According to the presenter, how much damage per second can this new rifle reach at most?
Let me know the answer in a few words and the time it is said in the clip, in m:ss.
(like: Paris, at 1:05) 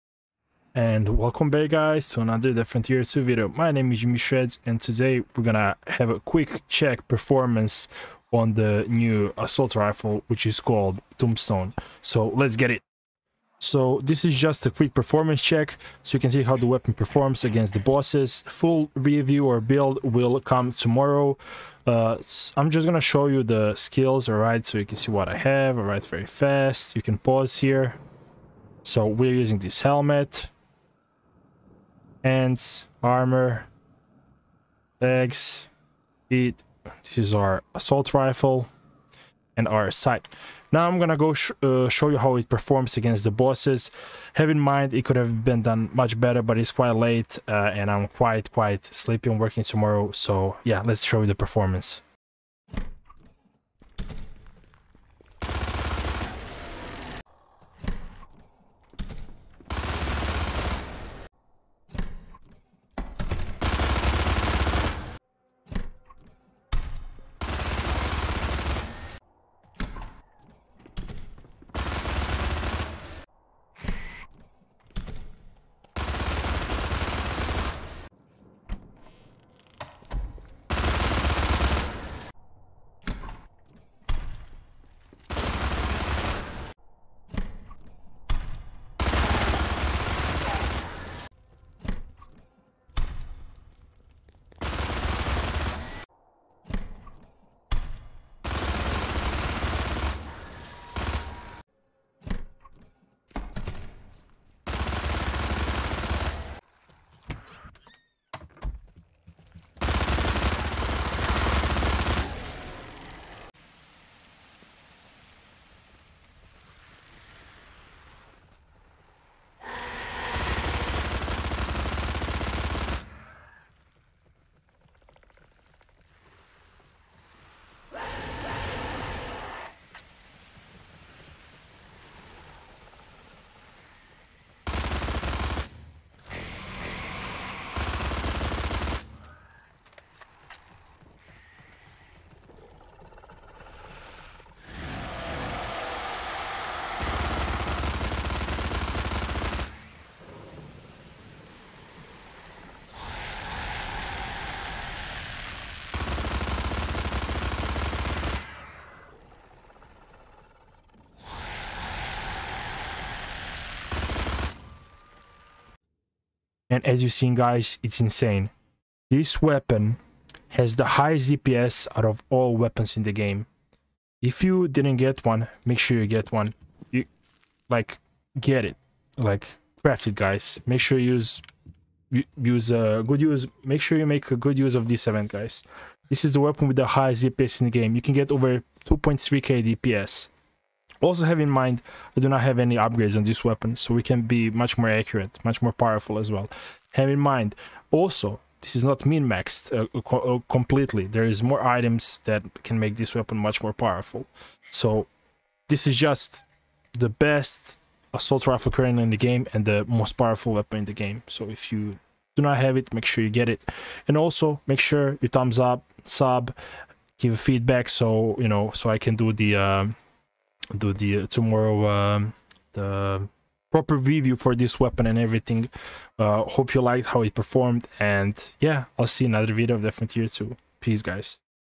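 over 2.3k, at 3:08.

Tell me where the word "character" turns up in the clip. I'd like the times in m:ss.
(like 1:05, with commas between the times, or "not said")
not said.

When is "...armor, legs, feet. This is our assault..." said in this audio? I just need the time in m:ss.
0:33.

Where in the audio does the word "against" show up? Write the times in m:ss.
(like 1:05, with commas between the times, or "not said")
0:17, 0:42.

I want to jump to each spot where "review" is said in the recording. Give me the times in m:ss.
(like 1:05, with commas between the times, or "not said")
0:18, 3:43.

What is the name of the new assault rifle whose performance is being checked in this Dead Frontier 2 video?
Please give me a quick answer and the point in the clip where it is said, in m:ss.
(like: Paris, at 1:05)
Tombstone, at 0:11.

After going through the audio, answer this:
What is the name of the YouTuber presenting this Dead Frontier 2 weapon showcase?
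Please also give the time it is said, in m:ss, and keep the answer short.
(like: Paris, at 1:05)
Jimmy Shredz, at 0:03.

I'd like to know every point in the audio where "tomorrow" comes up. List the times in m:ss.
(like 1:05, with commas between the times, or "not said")
0:20, 0:49, 3:41.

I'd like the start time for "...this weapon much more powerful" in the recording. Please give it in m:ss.
3:22.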